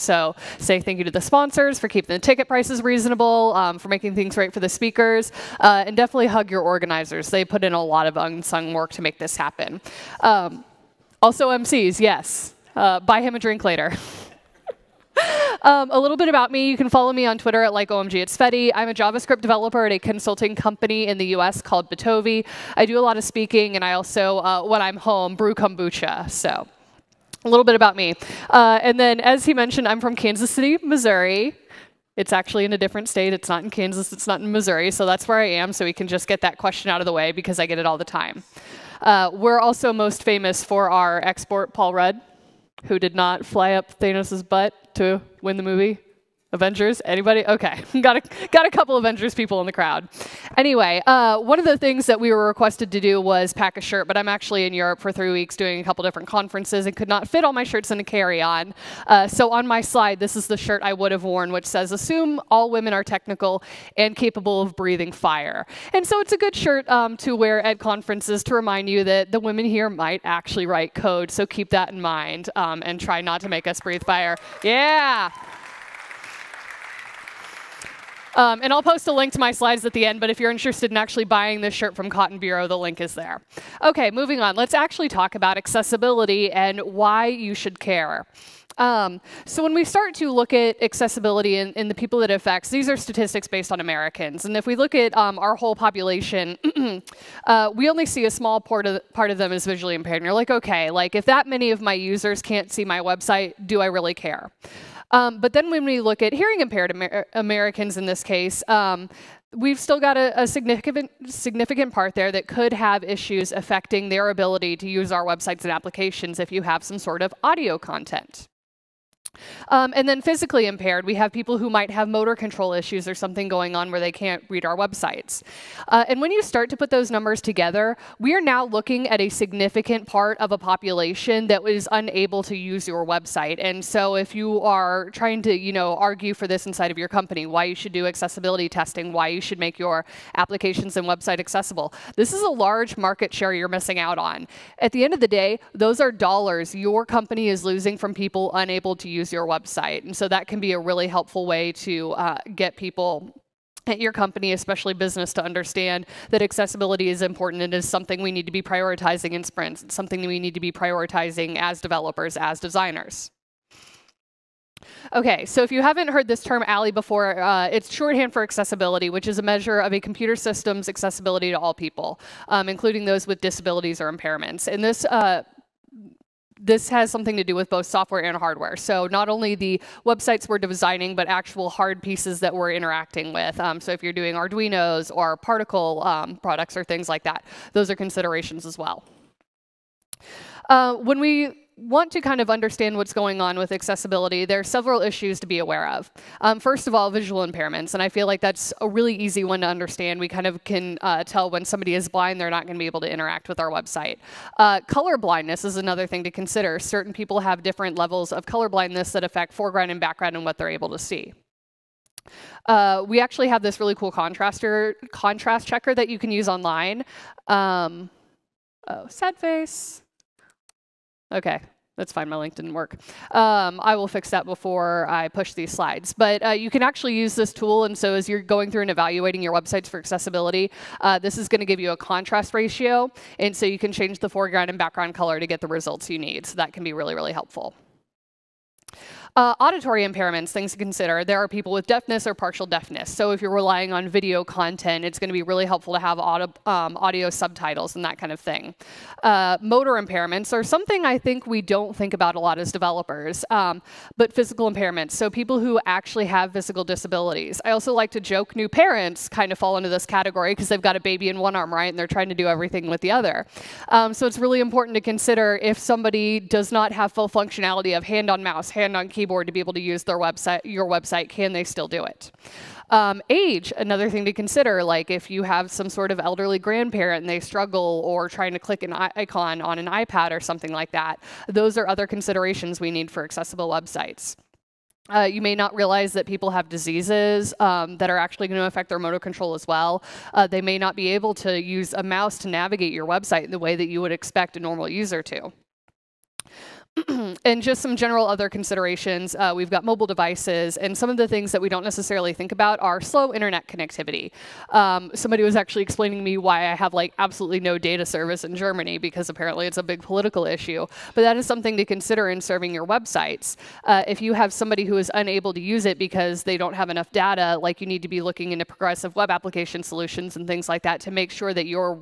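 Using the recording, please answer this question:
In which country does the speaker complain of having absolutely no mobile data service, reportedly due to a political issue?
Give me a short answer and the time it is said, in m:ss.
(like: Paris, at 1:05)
Germany, at 5:08.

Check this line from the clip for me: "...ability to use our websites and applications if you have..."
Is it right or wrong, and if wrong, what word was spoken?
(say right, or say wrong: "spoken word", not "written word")
right.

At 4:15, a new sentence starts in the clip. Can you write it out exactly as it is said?
So people who actually have physical disabilities.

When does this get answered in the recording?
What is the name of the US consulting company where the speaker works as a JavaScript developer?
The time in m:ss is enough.
0:21.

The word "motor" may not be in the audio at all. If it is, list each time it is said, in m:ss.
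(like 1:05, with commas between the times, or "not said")
2:02, 4:09, 4:48.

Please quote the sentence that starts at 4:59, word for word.
Uh, we've got mobile devices, and some of the things that we don't necessarily think about are slow internet connectivity.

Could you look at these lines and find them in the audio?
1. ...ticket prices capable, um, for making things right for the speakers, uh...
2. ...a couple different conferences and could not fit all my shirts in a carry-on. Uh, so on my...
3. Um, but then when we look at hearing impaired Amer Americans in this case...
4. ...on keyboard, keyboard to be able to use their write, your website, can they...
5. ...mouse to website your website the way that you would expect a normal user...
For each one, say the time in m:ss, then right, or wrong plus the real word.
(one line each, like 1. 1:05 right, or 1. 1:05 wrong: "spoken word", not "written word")
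1. 0:02 wrong: "reasonable", not "capable"
2. 0:55 right
3. 1:45 right
4. 4:28 wrong: "website", not "write"
5. 4:52 wrong: "navigate", not "website".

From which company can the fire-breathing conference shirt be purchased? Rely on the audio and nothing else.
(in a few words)
Cotton Bureau.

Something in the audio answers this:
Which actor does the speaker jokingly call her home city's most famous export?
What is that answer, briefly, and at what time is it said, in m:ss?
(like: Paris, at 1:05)
Paul Rudd, at 0:41.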